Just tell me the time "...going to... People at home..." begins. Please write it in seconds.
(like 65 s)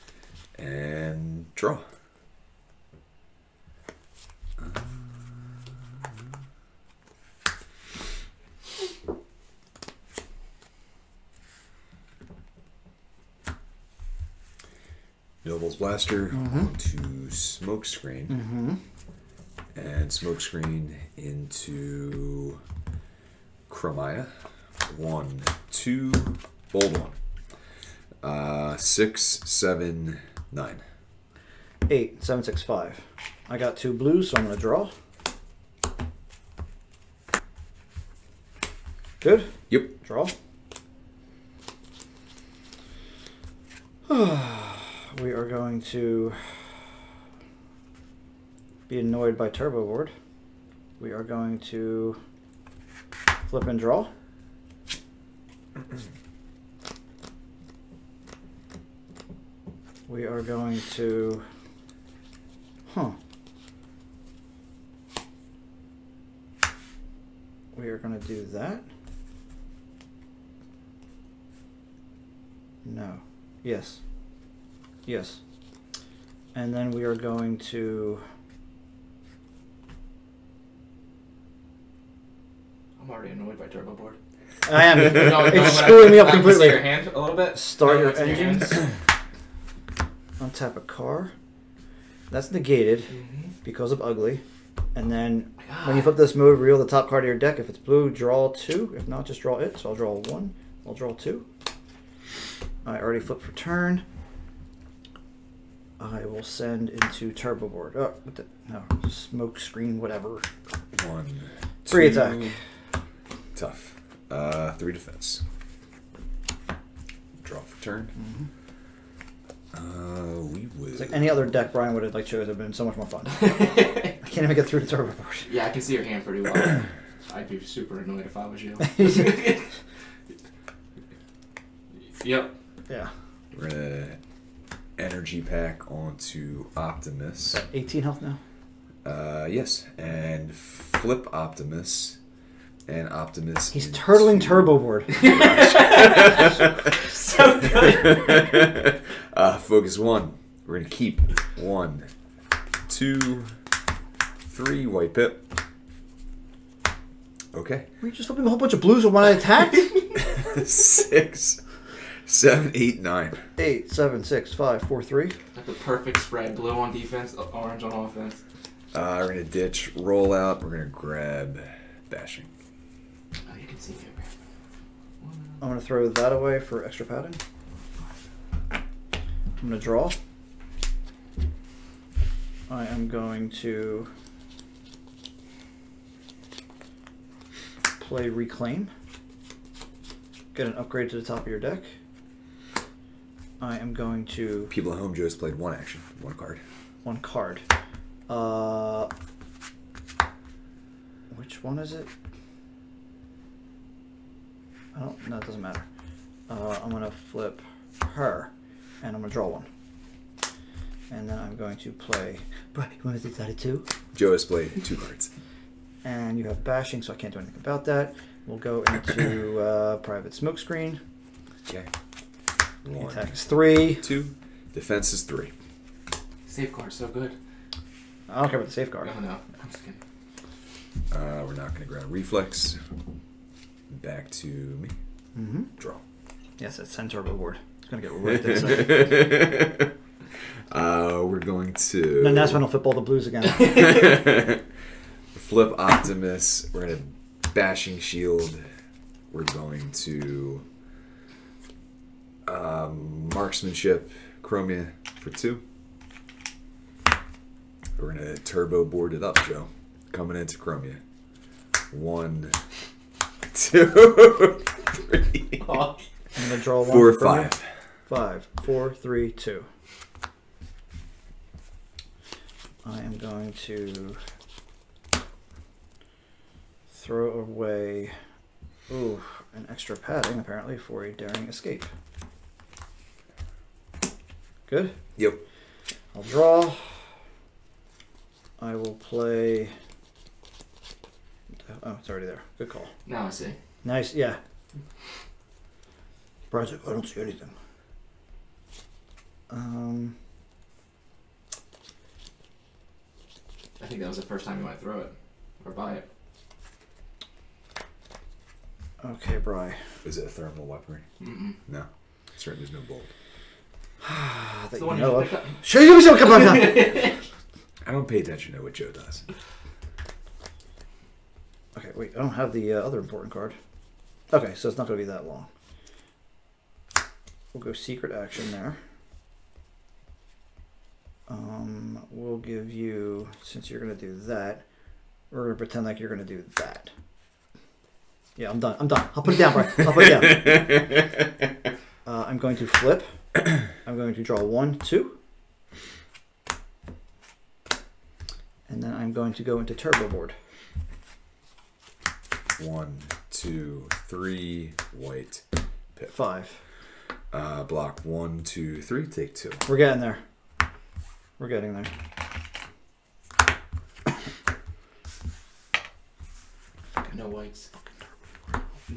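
193 s.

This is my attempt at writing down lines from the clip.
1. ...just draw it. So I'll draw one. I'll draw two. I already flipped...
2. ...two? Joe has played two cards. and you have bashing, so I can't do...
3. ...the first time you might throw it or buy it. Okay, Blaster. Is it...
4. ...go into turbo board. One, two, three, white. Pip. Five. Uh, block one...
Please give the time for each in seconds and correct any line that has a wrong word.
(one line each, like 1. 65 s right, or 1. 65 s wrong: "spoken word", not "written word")
1. 99 s right
2. 213 s right
3. 304 s wrong: "Bry", not "Blaster"
4. 349 s right.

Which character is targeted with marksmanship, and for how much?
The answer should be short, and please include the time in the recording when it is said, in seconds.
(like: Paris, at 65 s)
Chromia, for two, at 254 s.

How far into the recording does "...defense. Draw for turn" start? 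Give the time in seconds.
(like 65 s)
114 s.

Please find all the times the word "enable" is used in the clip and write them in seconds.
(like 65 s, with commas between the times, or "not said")
not said.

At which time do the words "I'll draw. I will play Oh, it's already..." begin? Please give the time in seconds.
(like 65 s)
286 s.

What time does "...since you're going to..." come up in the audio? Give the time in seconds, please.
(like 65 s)
333 s.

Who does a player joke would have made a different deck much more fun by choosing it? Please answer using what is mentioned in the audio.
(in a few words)
Brian.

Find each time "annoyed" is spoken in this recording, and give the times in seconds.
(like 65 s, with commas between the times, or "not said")
48 s, 83 s, 127 s.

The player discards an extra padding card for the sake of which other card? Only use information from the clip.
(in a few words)
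Daring Escape.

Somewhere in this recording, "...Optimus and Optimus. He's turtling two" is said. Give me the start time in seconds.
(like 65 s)
141 s.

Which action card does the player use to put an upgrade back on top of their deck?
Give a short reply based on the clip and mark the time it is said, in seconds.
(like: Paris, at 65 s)
Reclaim, at 188 s.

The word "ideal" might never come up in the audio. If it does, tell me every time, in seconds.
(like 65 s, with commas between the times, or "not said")
not said.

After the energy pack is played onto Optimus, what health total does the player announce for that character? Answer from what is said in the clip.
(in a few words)
18.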